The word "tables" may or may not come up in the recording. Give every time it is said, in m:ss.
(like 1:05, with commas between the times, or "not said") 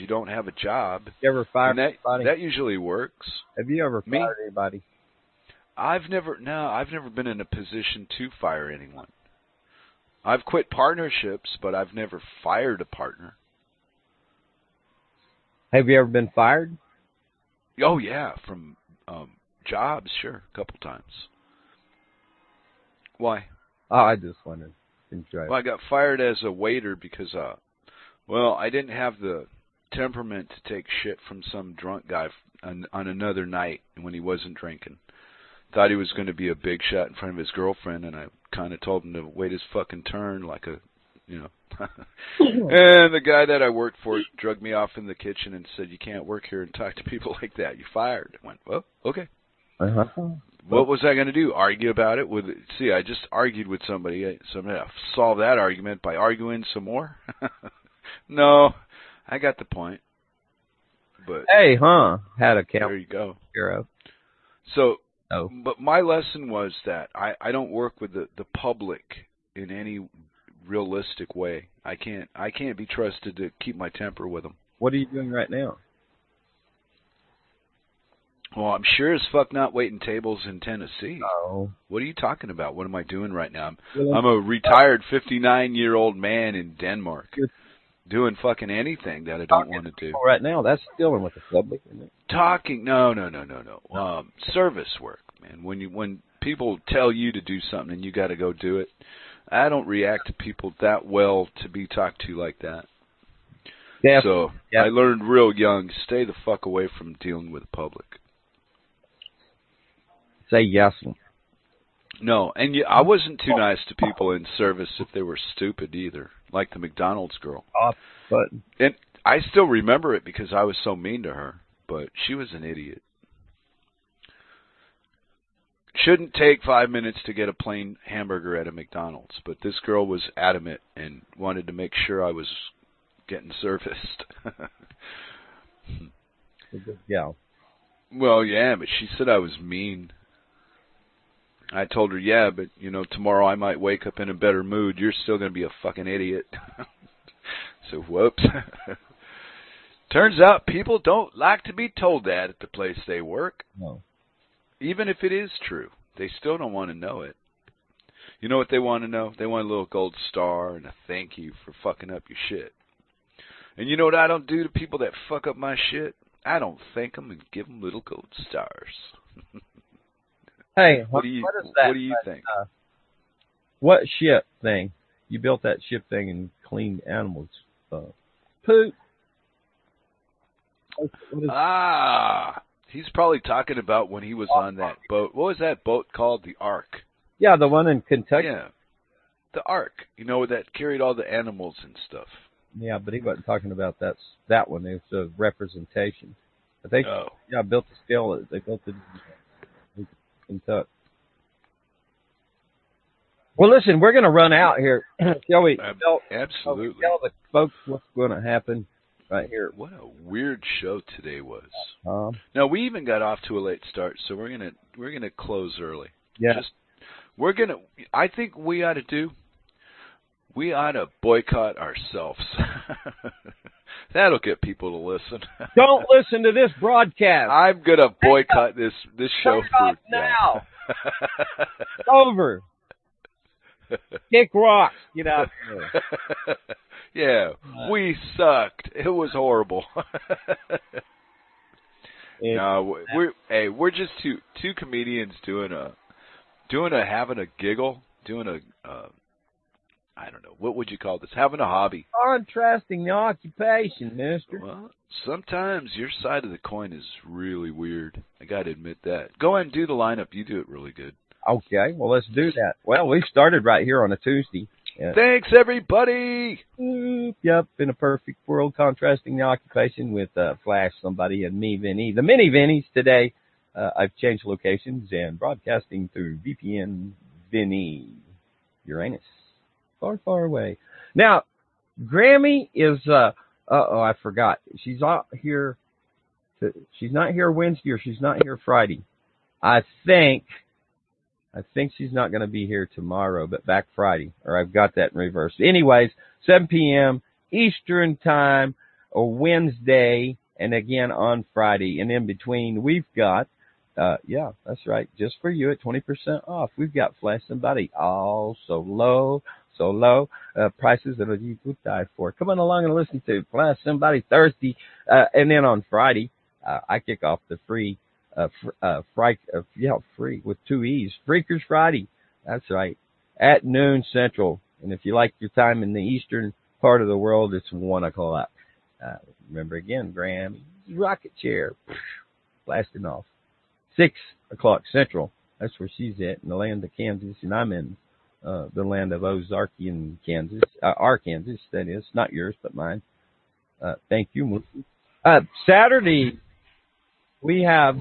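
1:19.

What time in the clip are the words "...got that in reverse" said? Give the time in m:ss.
4:54.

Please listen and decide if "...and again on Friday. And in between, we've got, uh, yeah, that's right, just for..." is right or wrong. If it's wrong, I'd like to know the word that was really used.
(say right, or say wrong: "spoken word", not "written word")
right.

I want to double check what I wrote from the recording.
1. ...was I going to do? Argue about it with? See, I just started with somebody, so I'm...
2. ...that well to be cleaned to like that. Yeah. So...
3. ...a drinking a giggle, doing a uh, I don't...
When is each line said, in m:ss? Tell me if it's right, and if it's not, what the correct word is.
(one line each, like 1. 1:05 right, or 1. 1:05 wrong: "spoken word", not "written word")
1. 0:50 wrong: "argued", not "started"
2. 1:40 wrong: "talked", not "cleaned"
3. 4:06 wrong: "having", not "drinking".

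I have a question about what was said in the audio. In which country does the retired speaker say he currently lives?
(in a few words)
Denmark.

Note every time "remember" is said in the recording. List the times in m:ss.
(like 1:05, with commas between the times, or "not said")
1:59, 5:29.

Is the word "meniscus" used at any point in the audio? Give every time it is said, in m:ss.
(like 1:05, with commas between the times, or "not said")
not said.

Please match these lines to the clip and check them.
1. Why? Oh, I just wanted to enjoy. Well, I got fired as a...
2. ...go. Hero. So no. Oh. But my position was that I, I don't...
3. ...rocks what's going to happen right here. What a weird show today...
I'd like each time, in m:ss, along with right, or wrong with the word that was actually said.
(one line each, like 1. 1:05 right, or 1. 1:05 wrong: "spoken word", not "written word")
1. 0:23 right
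2. 1:03 wrong: "lesson", not "position"
3. 3:27 wrong: "folks", not "rocks".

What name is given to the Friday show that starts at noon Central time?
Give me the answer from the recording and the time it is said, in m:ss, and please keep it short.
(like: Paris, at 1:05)
Freakers Friday, at 5:21.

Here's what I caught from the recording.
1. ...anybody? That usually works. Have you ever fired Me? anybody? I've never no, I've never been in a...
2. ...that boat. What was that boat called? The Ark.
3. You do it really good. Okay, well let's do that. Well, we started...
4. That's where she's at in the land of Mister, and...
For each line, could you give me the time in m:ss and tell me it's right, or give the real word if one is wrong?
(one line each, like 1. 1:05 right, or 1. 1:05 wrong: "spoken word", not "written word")
1. 0:02 right
2. 3:04 right
3. 4:20 right
4. 5:35 wrong: "Kansas", not "Mister".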